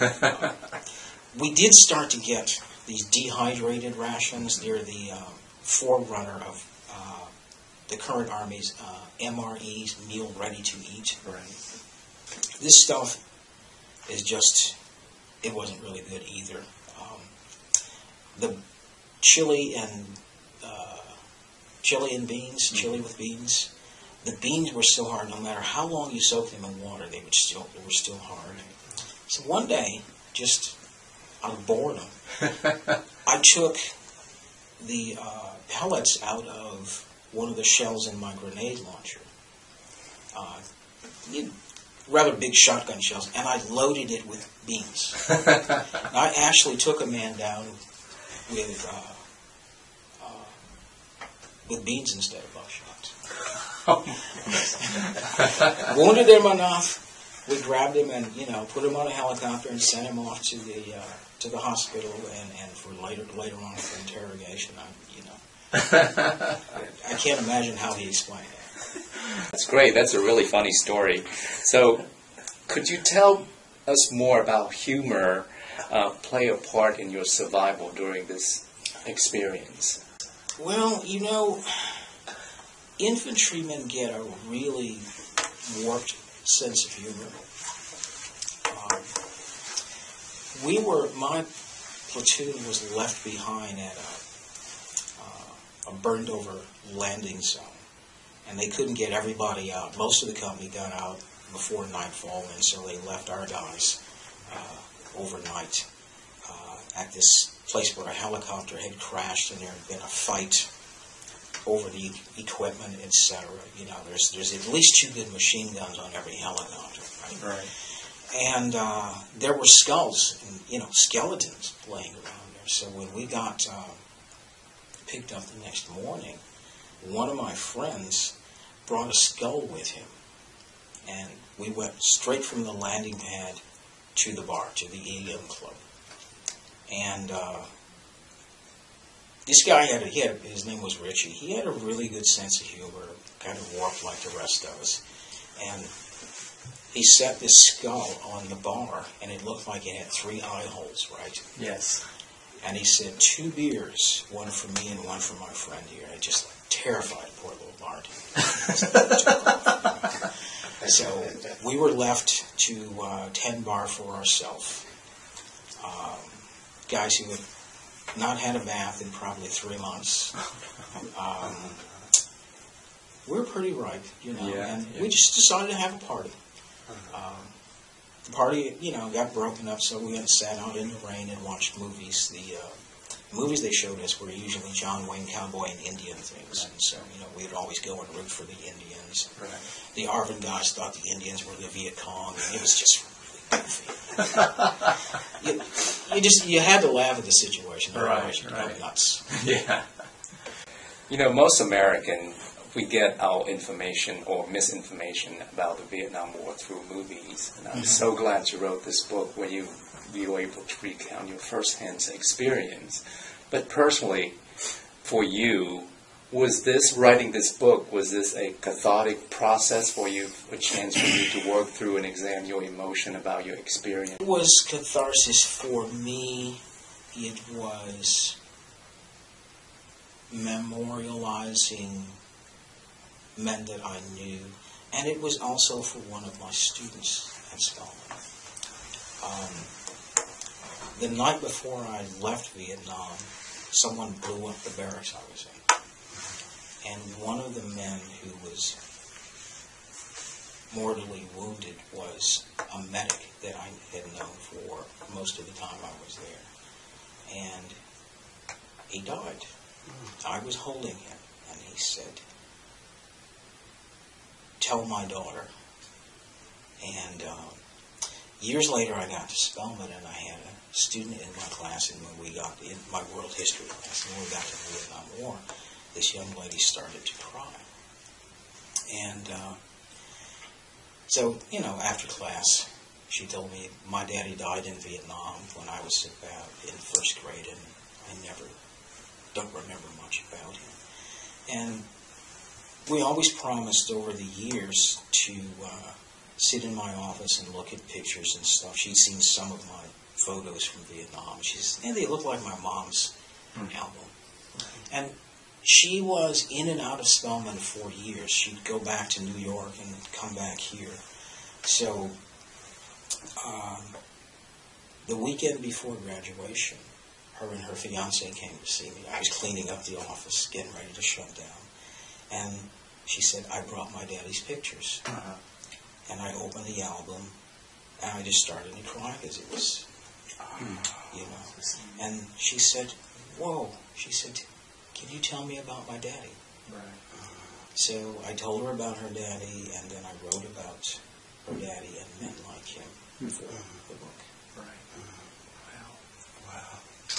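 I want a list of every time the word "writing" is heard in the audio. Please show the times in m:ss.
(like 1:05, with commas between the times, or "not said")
3:36.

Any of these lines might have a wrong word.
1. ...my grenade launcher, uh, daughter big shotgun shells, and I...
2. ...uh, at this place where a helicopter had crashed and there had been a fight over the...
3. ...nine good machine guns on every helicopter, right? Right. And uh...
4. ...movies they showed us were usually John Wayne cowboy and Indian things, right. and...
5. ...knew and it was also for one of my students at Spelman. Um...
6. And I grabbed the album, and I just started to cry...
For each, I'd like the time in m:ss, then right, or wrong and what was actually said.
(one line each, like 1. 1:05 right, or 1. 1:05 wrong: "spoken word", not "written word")
1. 0:38 wrong: "rather", not "daughter"
2. 1:46 right
3. 1:54 wrong: "two", not "nine"
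4. 3:03 right
5. 3:54 right
6. 5:26 wrong: "opened", not "grabbed".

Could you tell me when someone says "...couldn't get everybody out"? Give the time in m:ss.
1:38.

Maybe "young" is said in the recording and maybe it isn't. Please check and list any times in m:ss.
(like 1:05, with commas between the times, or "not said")
4:36.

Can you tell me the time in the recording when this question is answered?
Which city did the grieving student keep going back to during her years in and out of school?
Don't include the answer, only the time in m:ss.
5:09.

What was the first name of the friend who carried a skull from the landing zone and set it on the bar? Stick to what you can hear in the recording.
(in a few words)
Richie.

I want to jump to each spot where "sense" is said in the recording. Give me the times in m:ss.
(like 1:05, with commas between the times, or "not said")
1:26, 2:22.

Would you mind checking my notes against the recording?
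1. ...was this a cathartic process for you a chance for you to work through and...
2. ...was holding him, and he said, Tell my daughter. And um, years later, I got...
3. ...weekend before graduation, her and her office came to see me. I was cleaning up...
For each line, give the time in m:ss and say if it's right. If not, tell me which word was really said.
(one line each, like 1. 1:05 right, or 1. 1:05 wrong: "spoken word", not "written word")
1. 3:37 right
2. 4:20 right
3. 5:15 wrong: "fiance", not "office".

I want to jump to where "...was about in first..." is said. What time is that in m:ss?
4:45.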